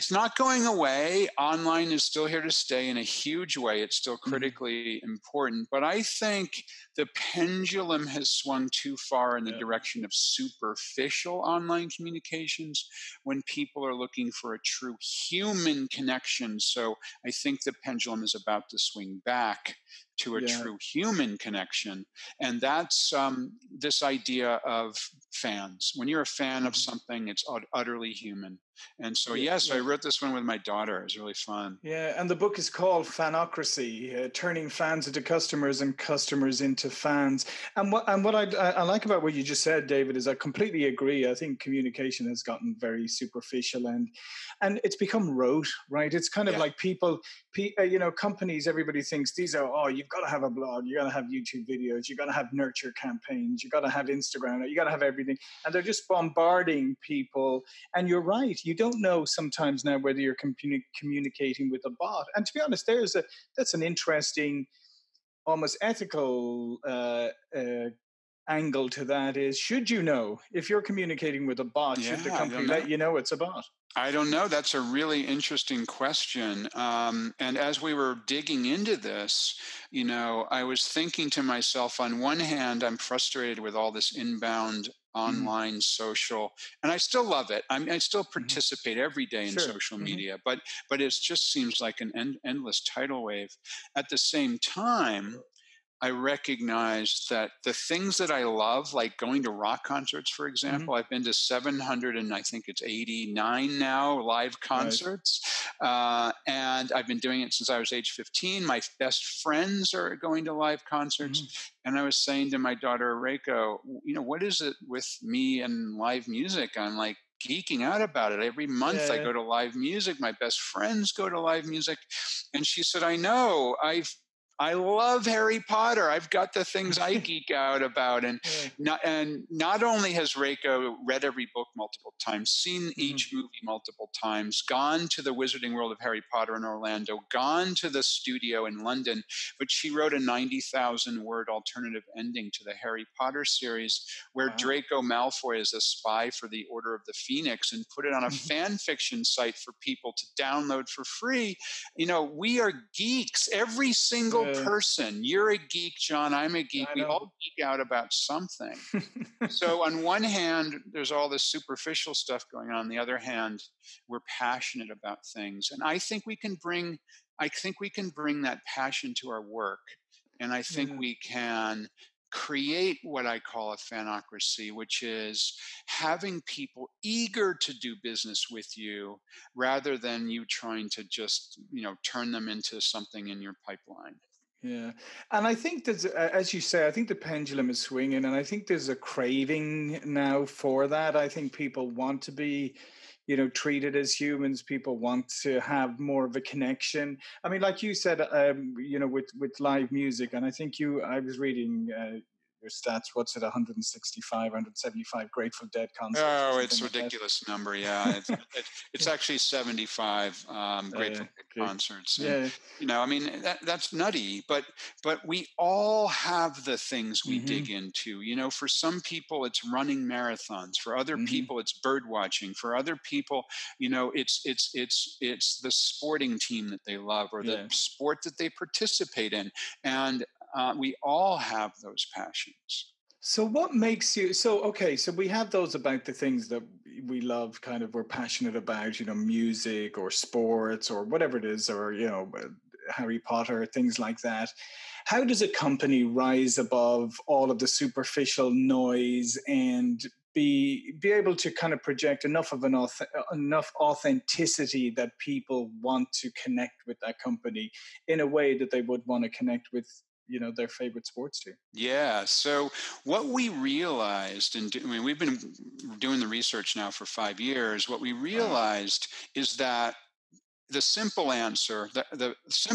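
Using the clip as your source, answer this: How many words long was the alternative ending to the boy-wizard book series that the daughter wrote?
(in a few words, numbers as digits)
90,000.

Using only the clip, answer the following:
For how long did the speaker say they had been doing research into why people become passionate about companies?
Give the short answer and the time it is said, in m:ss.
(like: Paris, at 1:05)
5 years, at 4:27.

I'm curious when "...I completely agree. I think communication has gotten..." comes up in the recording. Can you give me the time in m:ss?
0:40.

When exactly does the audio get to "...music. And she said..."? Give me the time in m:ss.
2:01.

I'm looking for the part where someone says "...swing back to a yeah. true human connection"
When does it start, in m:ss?
0:18.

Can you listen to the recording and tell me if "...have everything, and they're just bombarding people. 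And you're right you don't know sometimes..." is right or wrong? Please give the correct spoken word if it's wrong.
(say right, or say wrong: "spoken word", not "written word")
right.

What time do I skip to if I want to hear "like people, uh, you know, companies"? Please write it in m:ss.
0:46.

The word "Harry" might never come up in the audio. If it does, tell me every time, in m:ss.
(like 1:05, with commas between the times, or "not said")
2:05, 2:15, 2:22, 4:02.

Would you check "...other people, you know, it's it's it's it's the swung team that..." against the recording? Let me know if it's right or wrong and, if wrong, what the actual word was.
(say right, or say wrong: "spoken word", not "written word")
wrong: "sporting", not "swung".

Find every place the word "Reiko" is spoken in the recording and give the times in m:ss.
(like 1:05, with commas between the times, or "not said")
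1:53, 2:10.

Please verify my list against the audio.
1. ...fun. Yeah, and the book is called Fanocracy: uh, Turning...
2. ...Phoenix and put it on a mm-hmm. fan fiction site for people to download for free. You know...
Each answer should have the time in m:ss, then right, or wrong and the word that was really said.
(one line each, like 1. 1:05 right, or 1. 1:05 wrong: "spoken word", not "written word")
1. 0:31 right
2. 2:27 right.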